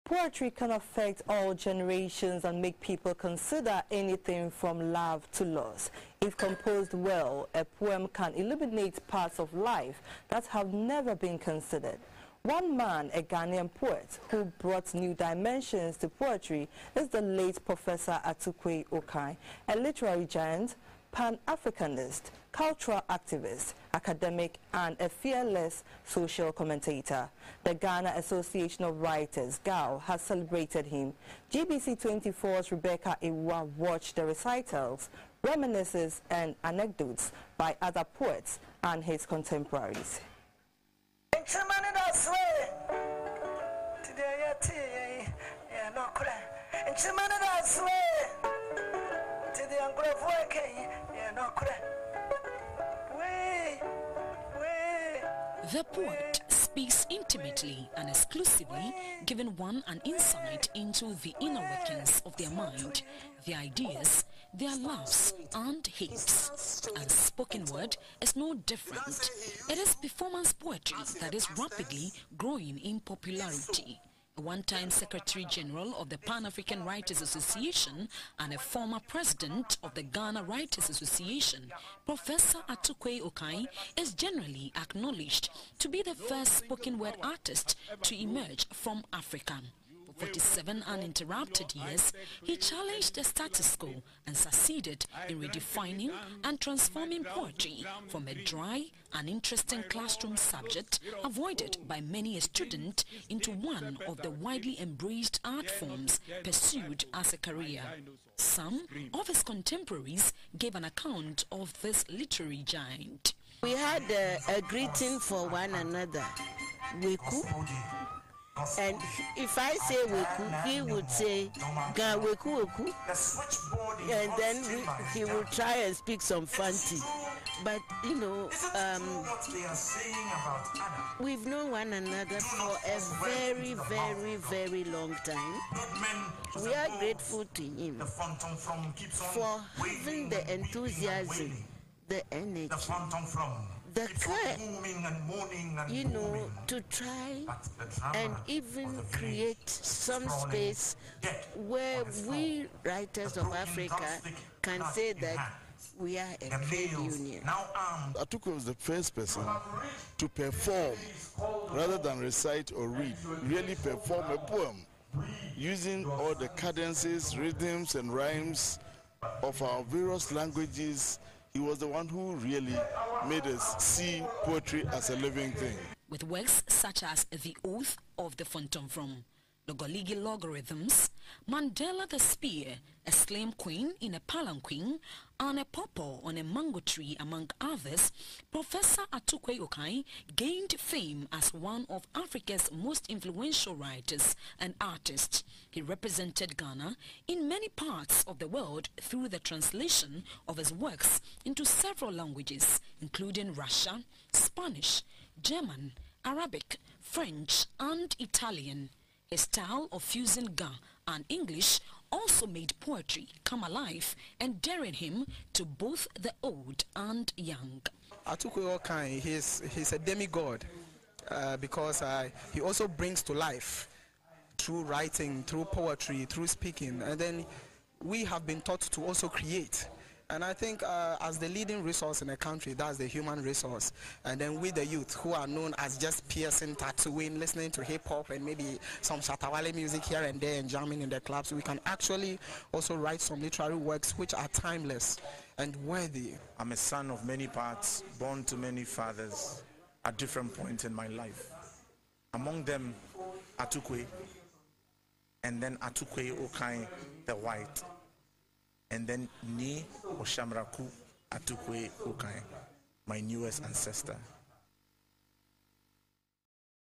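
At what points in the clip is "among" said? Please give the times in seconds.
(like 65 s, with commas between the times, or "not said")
187 s, 252 s.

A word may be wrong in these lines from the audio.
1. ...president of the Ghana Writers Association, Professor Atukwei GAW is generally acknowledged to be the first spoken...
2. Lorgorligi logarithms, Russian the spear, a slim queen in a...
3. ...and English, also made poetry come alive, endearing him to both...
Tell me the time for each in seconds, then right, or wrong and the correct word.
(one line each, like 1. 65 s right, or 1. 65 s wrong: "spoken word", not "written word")
1. 79 s wrong: "Okai", not "GAW"
2. 179 s wrong: "Mandela", not "Russian"
3. 211 s right.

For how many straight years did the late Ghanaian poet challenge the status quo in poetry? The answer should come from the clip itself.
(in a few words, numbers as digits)
47.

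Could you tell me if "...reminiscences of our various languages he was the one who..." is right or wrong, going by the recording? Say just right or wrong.
wrong.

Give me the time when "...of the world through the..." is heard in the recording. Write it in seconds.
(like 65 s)
198 s.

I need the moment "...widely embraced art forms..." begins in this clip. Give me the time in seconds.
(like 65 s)
104 s.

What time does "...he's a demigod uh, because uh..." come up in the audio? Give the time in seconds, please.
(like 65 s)
219 s.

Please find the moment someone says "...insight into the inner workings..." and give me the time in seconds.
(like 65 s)
60 s.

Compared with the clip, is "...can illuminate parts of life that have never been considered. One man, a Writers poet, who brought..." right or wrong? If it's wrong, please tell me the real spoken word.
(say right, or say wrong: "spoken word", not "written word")
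wrong: "Ghanaian", not "Writers".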